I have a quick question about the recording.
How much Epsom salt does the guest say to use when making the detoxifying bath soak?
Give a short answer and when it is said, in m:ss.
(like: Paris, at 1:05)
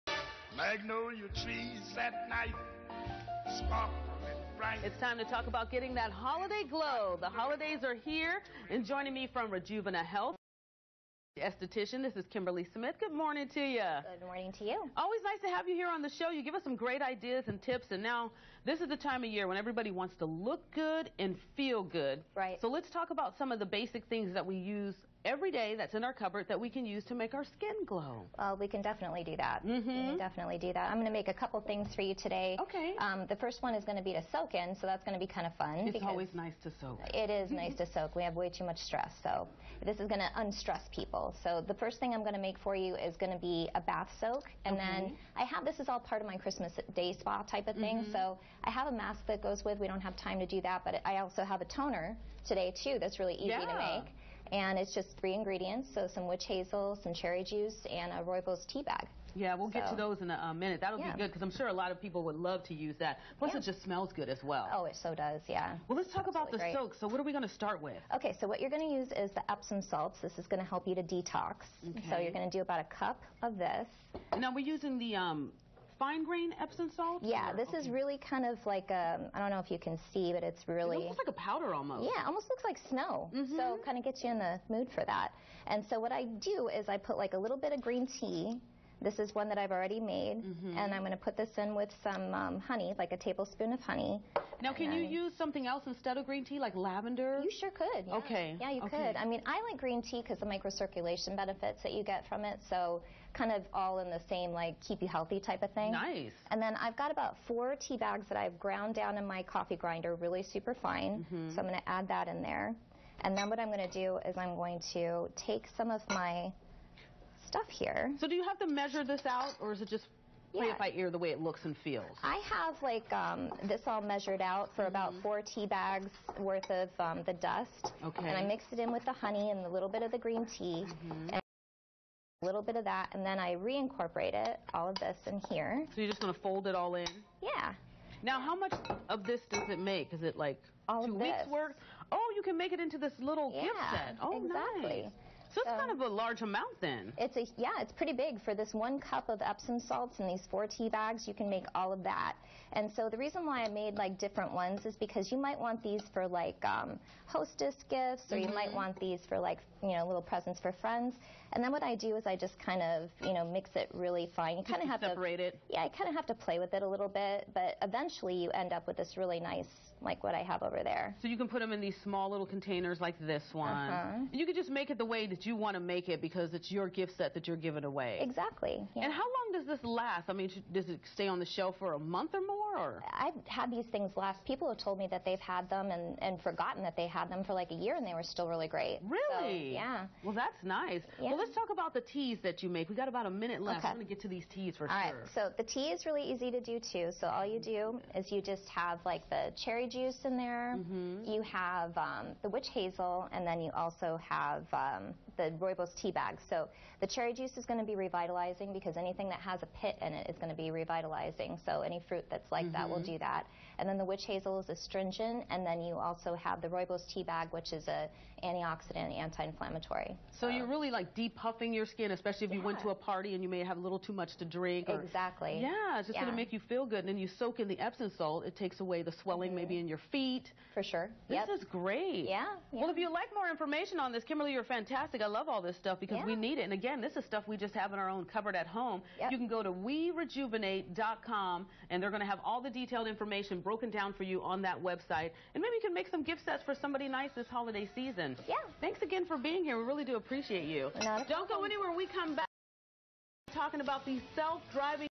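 a cup, at 1:12.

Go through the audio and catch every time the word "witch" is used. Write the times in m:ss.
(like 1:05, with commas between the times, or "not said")
0:56, 3:22, 3:34.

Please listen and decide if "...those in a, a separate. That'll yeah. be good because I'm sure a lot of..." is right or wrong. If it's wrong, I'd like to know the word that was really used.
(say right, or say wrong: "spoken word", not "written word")
wrong: "minute", not "separate".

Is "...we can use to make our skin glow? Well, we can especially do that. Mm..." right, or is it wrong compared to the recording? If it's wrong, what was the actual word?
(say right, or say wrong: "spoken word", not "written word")
wrong: "definitely", not "especially".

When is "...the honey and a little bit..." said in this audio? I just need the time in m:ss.
2:09.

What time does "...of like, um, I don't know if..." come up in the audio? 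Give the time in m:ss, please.
1:18.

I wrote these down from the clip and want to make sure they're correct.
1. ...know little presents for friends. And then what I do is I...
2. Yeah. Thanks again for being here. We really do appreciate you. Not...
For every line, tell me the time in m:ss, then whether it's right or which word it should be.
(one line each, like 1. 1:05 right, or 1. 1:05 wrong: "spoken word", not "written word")
1. 2:39 right
2. 4:08 right.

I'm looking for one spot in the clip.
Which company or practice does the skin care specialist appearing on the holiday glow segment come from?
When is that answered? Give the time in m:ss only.
0:09.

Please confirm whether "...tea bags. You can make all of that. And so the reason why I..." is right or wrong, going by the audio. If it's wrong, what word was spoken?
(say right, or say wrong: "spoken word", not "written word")
right.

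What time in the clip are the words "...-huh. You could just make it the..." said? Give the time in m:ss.
2:53.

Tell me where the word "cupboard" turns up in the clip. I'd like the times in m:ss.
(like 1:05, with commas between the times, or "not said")
0:26, 3:58.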